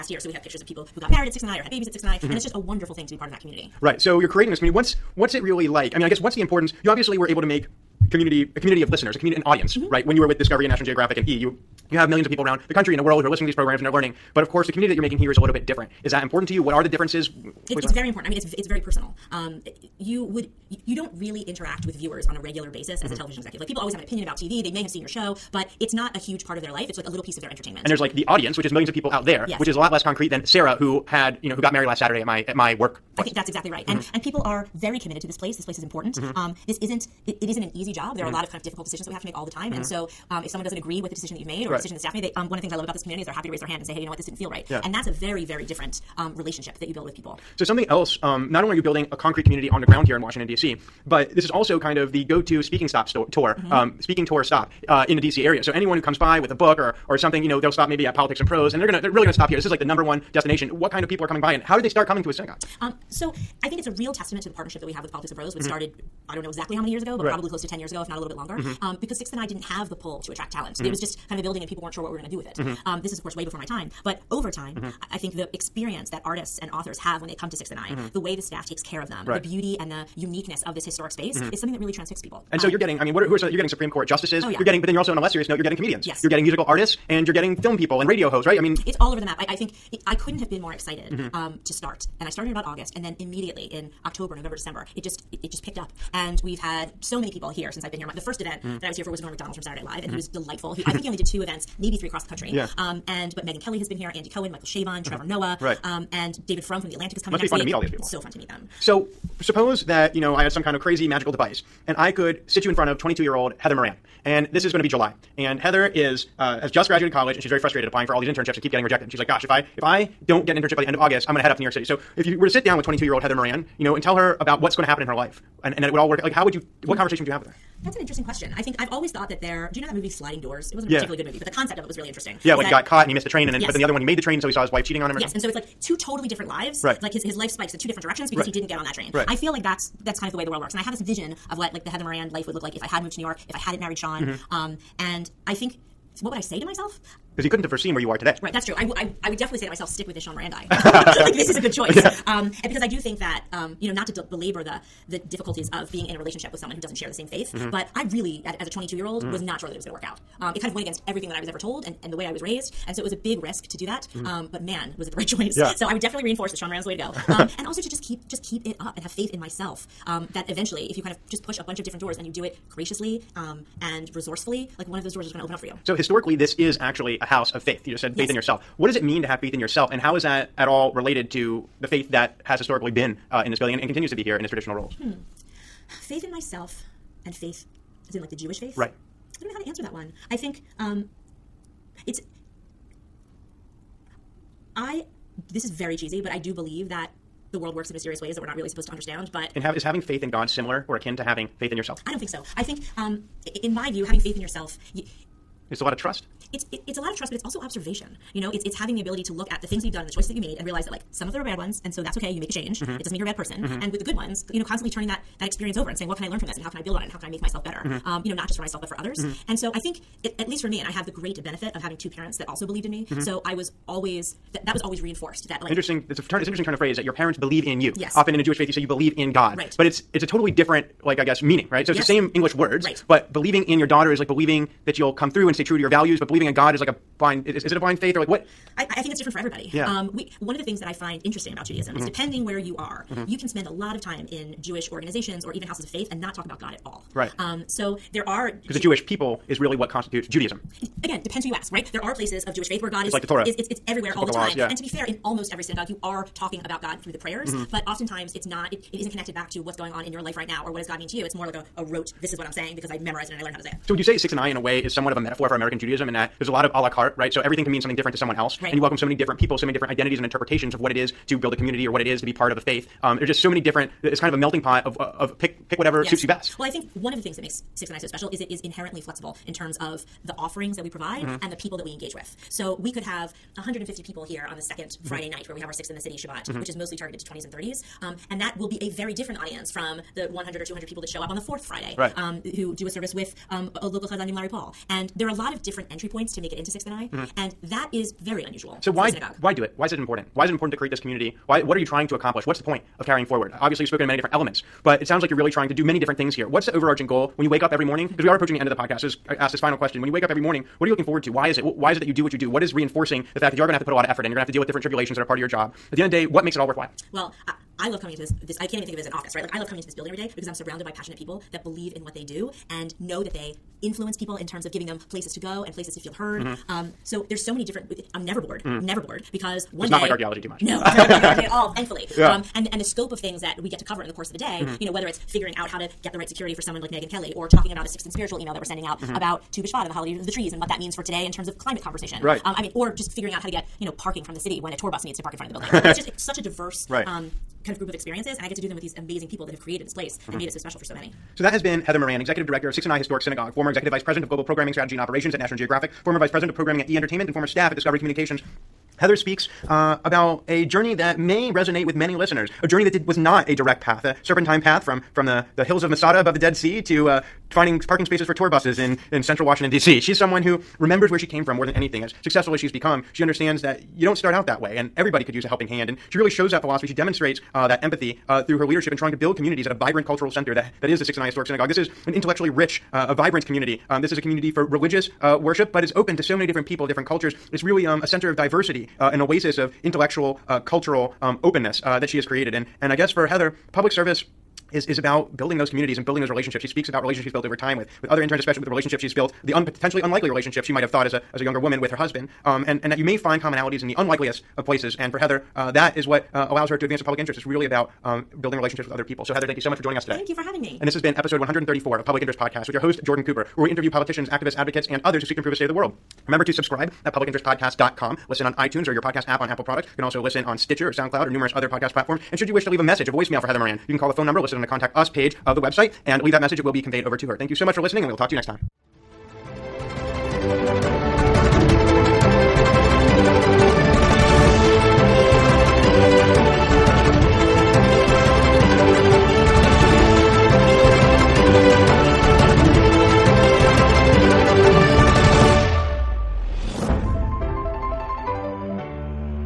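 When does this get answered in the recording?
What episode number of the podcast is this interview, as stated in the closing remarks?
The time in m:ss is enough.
6:51.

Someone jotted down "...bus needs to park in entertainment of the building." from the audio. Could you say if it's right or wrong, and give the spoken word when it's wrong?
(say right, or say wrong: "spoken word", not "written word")
wrong: "front", not "entertainment".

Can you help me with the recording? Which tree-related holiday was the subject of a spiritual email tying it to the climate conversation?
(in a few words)
Tu B'Shvat.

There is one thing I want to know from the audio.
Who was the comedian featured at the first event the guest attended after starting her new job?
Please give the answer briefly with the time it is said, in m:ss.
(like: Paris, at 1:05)
Norm Macdonald, at 1:39.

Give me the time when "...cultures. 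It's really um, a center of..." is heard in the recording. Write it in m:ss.
6:27.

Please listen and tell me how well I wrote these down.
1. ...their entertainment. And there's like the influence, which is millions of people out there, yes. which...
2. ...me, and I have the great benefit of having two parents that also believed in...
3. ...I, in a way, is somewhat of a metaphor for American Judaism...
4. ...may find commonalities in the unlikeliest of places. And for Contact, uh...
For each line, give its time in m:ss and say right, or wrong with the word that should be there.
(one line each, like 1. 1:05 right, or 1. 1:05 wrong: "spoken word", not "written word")
1. 0:27 wrong: "audience", not "influence"
2. 3:40 right
3. 4:24 right
4. 6:43 wrong: "Heather", not "Contact".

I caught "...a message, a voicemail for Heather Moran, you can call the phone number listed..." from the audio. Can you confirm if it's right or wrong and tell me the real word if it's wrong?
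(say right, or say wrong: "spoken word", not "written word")
right.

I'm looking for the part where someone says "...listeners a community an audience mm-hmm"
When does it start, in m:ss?
0:08.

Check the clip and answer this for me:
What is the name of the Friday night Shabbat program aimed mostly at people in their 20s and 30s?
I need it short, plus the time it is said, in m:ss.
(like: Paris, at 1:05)
Sixth in the City, at 4:45.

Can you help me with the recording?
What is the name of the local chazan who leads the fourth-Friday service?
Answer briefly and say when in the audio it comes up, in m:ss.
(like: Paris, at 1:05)
Larry Paul, at 4:54.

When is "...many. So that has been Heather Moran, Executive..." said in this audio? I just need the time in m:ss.
5:50.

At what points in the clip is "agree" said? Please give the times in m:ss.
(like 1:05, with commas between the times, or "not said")
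0:40.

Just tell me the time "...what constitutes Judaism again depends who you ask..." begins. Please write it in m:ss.
4:09.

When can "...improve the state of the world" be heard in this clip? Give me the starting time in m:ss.
6:55.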